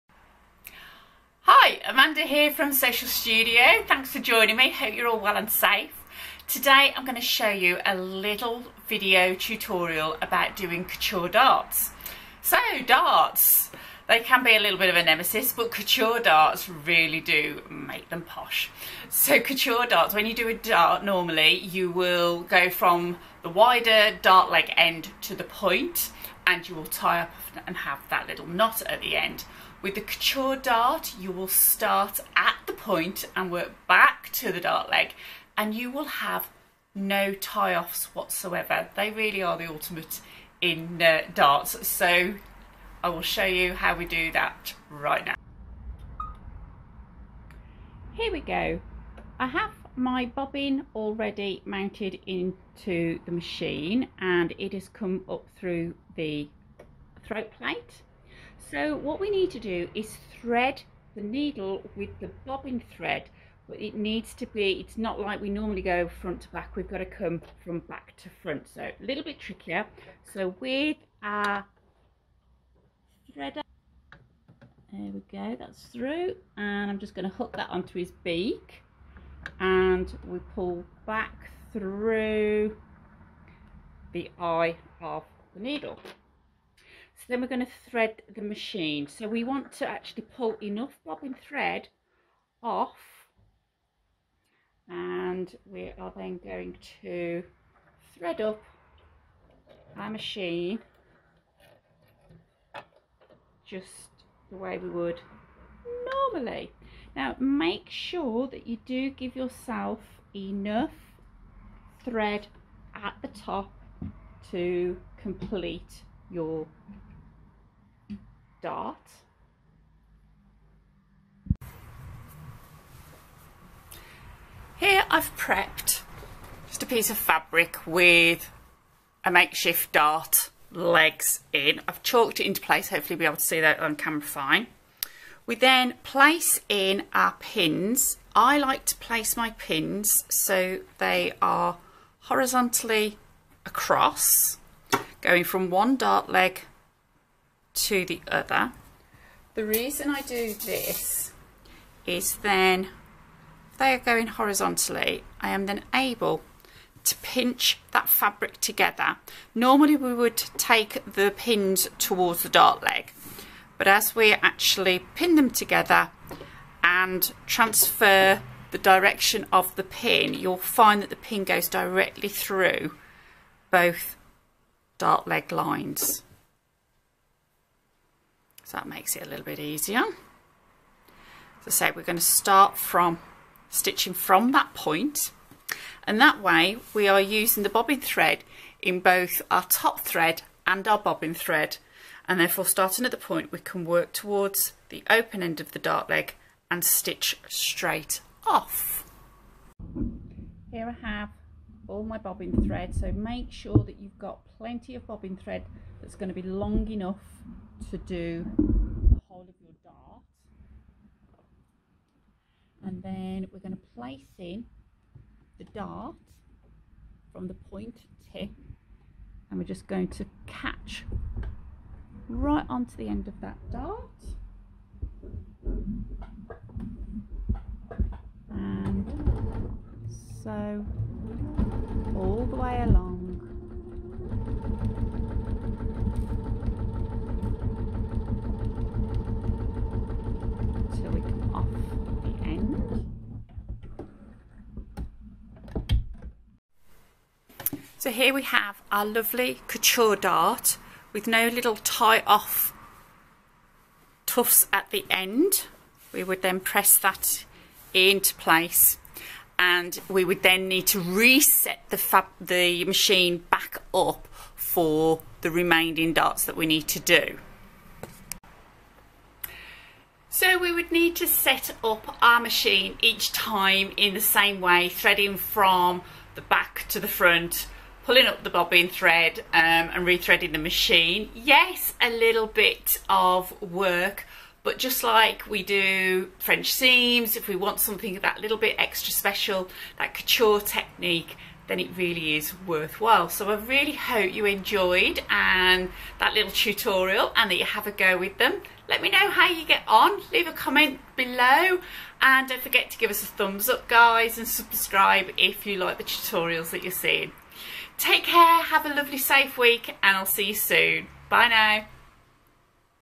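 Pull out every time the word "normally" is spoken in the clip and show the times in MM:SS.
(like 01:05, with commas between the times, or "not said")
00:21, 01:05, 01:46, 02:39.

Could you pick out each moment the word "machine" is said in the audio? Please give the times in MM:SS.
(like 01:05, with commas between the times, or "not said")
00:53, 01:28, 01:40, 04:22, 04:32, 04:40.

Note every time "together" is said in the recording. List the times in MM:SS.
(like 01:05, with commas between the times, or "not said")
02:38, 02:45.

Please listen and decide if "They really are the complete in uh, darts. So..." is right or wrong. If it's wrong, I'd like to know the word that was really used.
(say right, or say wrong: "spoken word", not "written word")
wrong: "ultimate", not "complete".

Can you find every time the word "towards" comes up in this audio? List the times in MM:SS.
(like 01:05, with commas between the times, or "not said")
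02:41, 03:14.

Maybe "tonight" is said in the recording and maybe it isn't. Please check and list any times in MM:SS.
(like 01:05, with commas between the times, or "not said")
not said.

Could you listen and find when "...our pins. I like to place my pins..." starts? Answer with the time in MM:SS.
02:17.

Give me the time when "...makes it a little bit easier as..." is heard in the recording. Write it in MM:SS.
02:58.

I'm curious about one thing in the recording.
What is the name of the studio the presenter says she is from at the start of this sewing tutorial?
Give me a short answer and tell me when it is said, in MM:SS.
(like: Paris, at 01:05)
Sewcial Studio, at 00:02.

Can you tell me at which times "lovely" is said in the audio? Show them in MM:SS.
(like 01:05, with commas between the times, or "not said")
04:09, 05:08.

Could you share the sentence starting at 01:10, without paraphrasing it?
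So with our threader, there we go, that's through.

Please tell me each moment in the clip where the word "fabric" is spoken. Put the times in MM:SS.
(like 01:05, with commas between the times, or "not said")
02:07, 02:38.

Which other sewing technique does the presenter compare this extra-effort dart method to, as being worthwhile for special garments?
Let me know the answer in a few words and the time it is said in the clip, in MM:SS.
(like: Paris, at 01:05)
French seams, at 04:46.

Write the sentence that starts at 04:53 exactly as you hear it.
So I really hope you enjoyed and that little tutorial and that you have a go with them.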